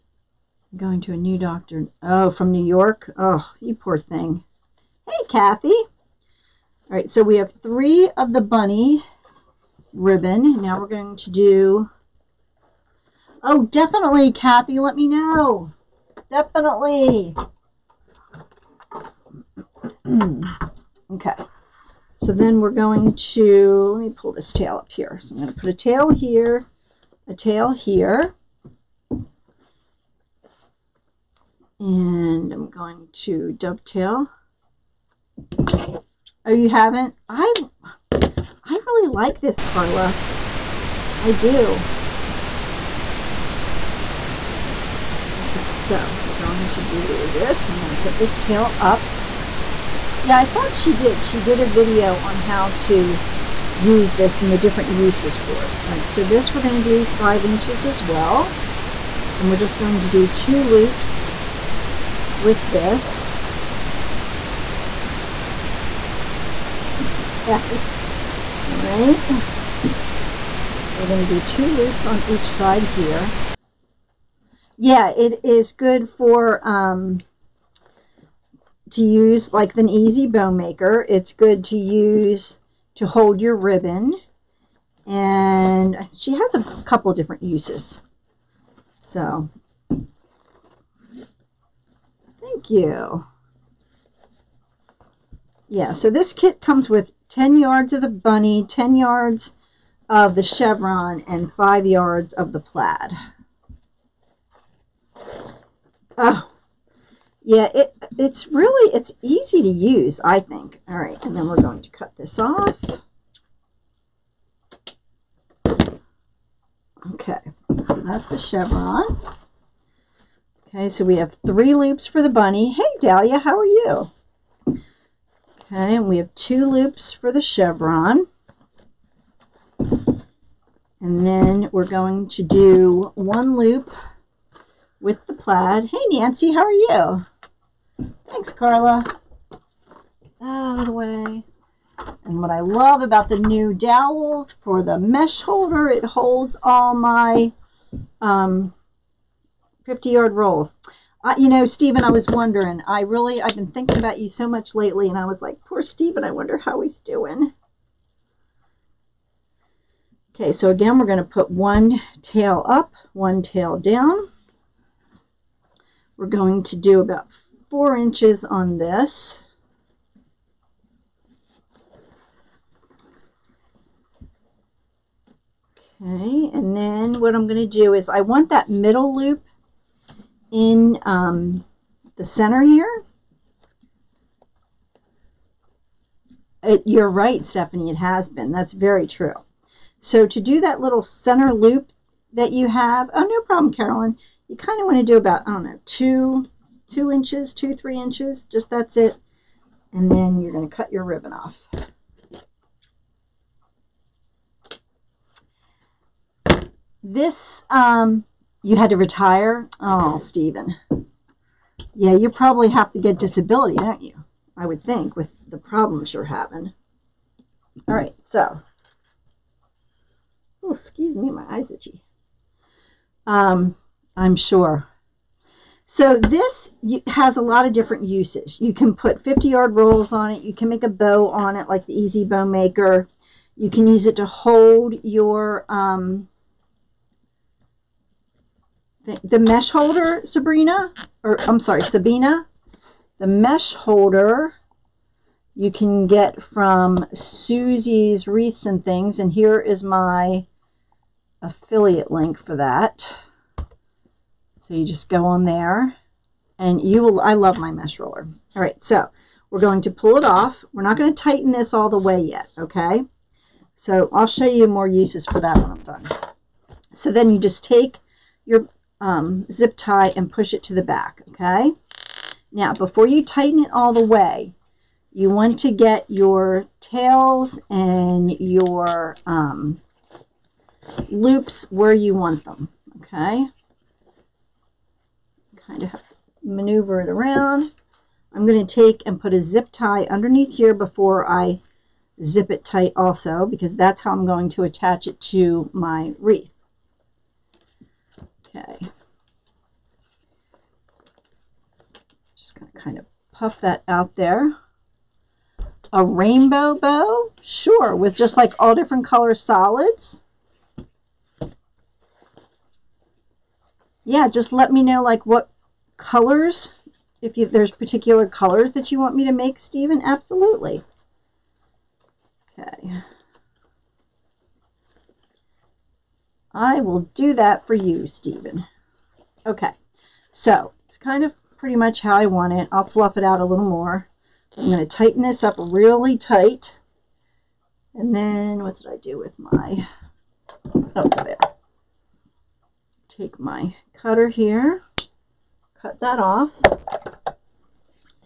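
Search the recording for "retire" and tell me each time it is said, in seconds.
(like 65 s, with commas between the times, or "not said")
208 s.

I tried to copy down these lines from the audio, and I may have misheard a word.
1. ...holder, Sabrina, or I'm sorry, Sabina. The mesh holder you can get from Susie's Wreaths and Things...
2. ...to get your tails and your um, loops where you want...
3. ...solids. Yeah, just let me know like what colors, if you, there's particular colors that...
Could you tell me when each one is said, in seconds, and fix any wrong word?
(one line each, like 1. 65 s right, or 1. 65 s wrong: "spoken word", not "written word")
1. 239 s right
2. 275 s right
3. 309 s right.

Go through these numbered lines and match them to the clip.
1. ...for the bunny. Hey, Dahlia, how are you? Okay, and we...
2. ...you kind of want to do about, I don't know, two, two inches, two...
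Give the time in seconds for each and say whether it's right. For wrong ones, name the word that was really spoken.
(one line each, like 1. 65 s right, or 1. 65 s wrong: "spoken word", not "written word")
1. 122 s right
2. 194 s right.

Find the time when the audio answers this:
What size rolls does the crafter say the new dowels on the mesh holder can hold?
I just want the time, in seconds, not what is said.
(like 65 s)
149 s.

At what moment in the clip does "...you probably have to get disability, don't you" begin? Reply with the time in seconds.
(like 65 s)
212 s.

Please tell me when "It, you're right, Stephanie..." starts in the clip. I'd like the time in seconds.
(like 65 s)
186 s.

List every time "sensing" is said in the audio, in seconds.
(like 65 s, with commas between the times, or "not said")
not said.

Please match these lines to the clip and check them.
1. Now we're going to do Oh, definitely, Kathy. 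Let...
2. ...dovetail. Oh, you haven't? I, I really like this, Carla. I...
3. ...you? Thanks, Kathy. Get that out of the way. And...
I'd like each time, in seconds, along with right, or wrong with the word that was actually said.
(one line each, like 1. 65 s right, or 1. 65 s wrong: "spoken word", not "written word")
1. 10 s right
2. 33 s right
3. 136 s wrong: "Carla", not "Kathy".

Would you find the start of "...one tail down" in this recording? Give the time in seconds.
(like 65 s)
163 s.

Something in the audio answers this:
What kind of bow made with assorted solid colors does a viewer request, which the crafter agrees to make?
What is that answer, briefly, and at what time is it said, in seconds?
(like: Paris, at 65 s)
Rainbow bow, at 305 s.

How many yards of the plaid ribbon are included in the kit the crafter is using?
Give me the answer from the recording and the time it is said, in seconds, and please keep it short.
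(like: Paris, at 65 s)
5 yards, at 101 s.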